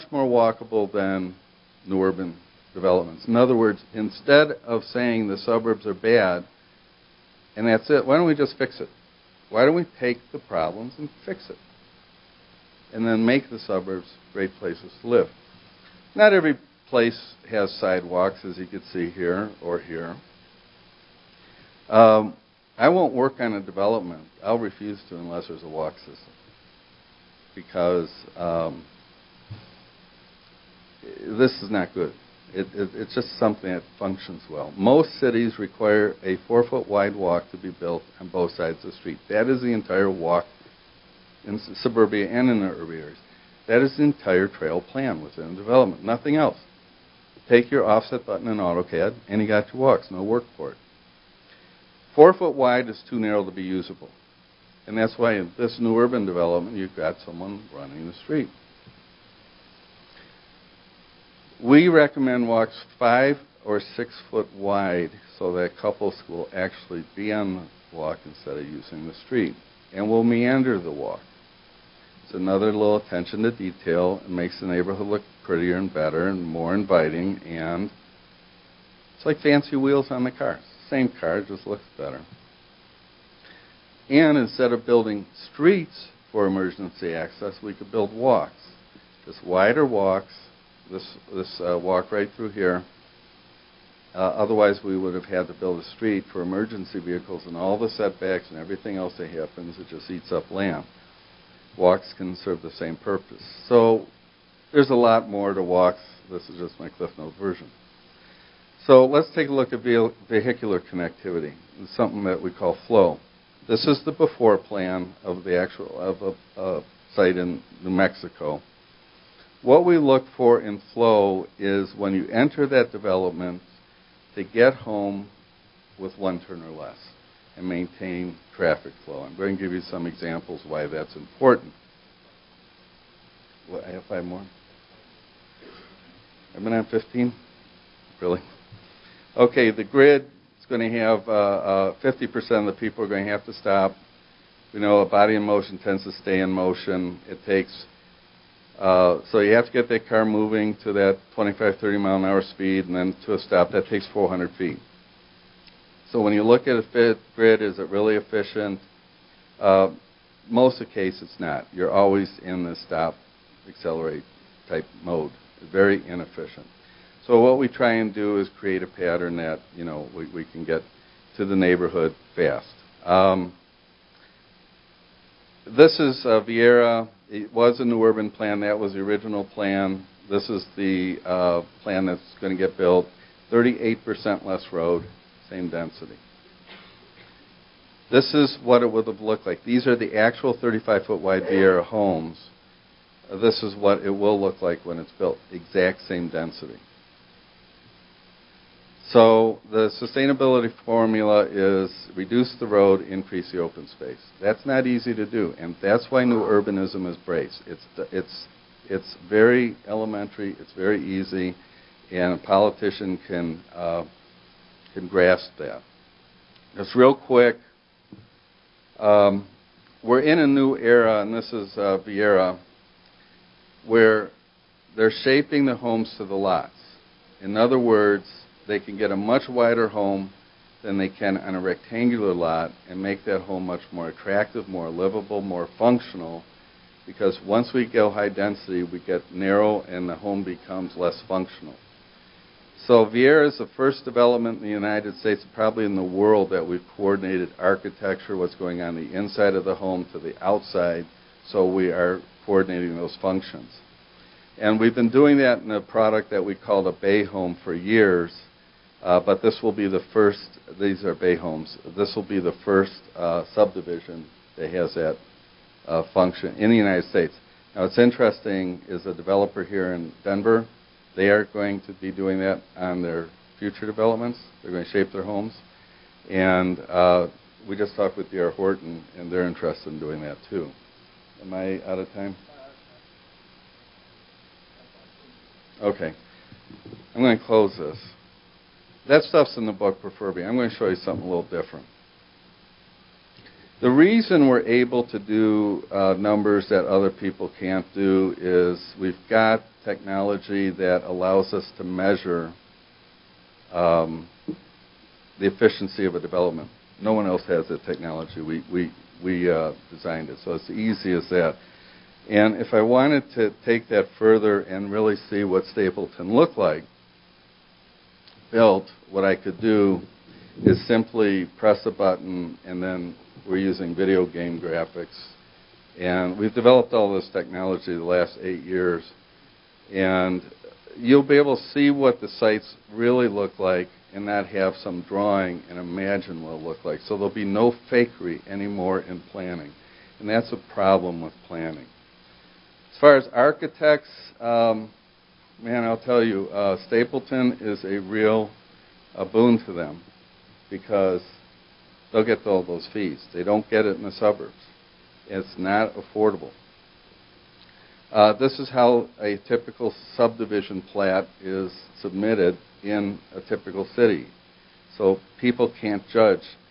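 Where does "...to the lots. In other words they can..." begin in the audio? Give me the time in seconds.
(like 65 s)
226 s.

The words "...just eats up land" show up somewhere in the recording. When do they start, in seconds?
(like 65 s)
99 s.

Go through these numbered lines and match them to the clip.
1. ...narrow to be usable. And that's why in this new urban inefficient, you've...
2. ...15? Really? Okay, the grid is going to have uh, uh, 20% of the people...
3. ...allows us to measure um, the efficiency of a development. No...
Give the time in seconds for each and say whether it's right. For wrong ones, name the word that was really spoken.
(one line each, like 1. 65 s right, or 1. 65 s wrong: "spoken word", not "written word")
1. 53 s wrong: "development", not "inefficient"
2. 136 s wrong: "50", not "20"
3. 301 s right.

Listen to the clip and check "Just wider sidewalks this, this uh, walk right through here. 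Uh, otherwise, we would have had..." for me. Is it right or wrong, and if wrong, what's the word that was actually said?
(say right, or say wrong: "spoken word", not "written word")
wrong: "walks", not "sidewalks".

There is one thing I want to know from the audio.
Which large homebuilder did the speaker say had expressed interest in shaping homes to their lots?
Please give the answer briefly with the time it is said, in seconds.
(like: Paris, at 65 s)
D.R. Horton, at 278 s.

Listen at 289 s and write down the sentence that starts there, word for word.
That stuff's in the book Prefurbia.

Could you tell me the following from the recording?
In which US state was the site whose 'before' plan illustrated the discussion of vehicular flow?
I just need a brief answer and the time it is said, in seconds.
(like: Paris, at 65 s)
New Mexico, at 117 s.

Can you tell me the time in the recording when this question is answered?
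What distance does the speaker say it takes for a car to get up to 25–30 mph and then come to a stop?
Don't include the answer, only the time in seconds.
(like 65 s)
154 s.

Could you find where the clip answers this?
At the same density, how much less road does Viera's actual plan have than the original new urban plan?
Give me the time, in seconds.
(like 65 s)
183 s.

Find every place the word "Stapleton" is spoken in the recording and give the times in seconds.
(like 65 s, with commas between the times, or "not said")
315 s, 346 s.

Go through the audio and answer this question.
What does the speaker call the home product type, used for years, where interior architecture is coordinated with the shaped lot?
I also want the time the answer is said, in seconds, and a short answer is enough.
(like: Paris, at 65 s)
bay home, at 257 s.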